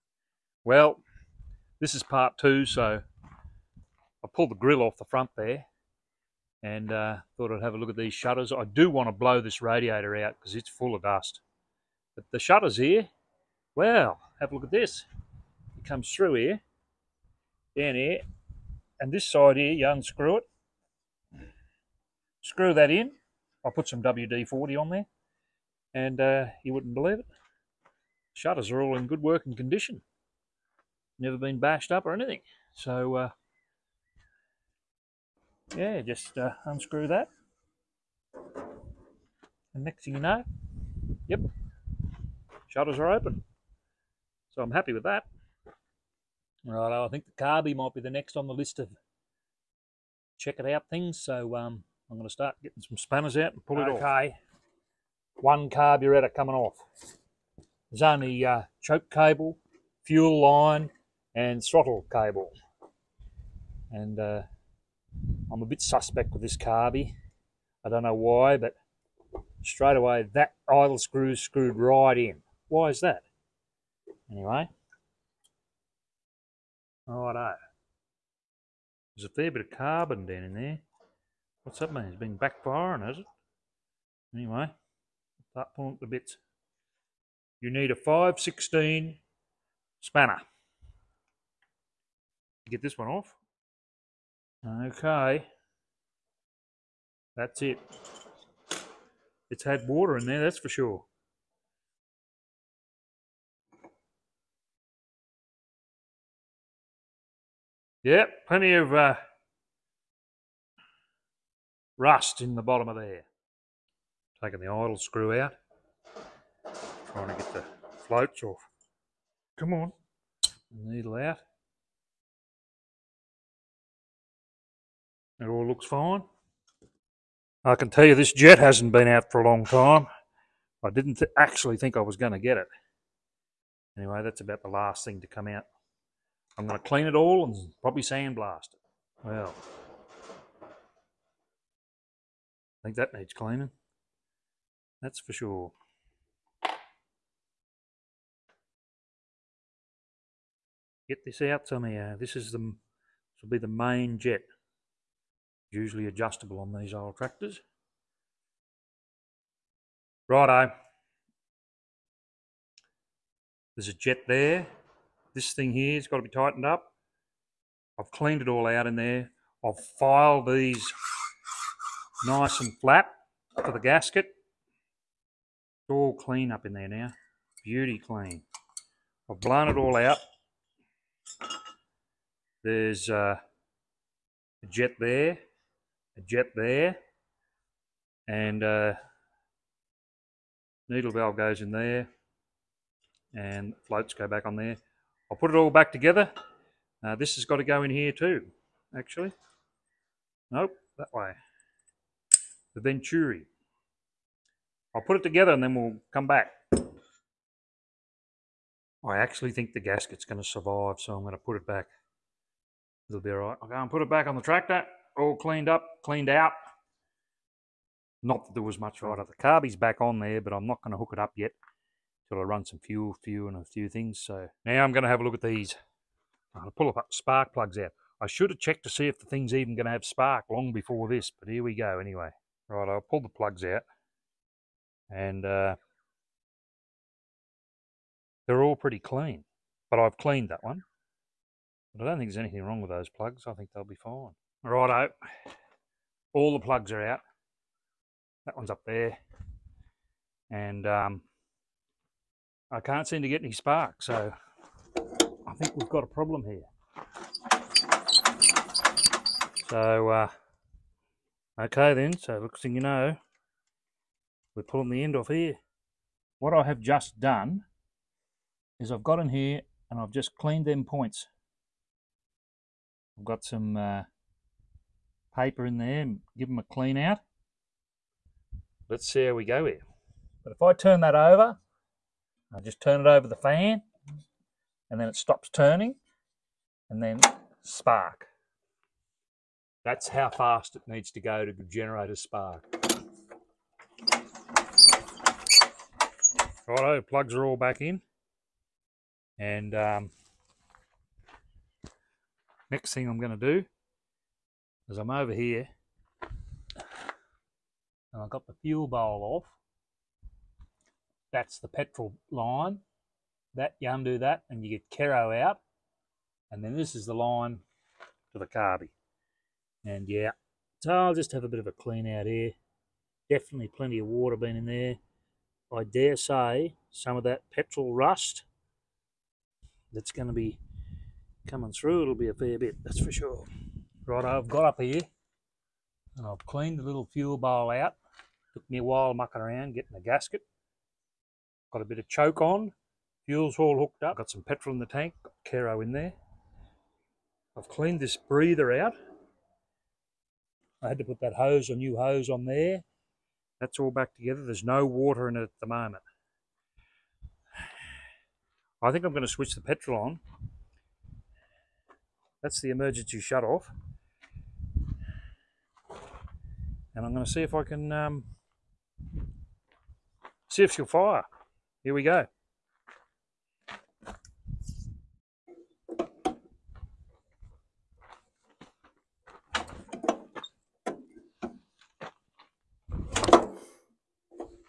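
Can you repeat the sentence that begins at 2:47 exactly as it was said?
I've cleaned it all out in there.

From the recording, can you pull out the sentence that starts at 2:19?
Well, I think that needs cleaning.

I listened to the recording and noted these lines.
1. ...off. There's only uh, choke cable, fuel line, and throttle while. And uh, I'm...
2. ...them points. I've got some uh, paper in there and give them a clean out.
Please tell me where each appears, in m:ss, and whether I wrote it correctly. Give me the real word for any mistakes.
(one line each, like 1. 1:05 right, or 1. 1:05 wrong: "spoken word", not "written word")
1. 0:56 wrong: "cable", not "while"
2. 4:30 right.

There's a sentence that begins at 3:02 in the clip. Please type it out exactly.
There's uh, a jet there, a jet there, and uh, needle valve goes in there, and floats go back on there.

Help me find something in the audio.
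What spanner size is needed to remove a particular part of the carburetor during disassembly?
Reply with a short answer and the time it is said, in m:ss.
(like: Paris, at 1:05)
5/16, at 1:27.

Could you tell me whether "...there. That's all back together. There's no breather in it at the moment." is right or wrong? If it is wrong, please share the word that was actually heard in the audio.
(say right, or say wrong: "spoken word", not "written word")
wrong: "water", not "breather".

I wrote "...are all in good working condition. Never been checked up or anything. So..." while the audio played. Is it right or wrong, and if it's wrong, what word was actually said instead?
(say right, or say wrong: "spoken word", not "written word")
wrong: "bashed", not "checked".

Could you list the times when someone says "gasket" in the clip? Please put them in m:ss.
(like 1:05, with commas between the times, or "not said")
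2:53, 3:29, 5:40.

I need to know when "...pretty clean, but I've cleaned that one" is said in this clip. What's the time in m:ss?
3:58.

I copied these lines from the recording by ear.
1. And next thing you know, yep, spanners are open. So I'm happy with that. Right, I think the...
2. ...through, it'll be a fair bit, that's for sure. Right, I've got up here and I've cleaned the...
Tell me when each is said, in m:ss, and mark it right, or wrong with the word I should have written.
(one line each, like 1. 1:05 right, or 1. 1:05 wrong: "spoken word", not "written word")
1. 0:39 wrong: "shutters", not "spanners"
2. 5:31 right.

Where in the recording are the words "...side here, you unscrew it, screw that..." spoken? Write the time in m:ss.
0:19.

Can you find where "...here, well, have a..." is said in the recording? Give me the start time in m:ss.
0:12.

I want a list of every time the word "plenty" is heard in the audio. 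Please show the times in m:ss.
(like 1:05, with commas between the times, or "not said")
1:48, 5:23.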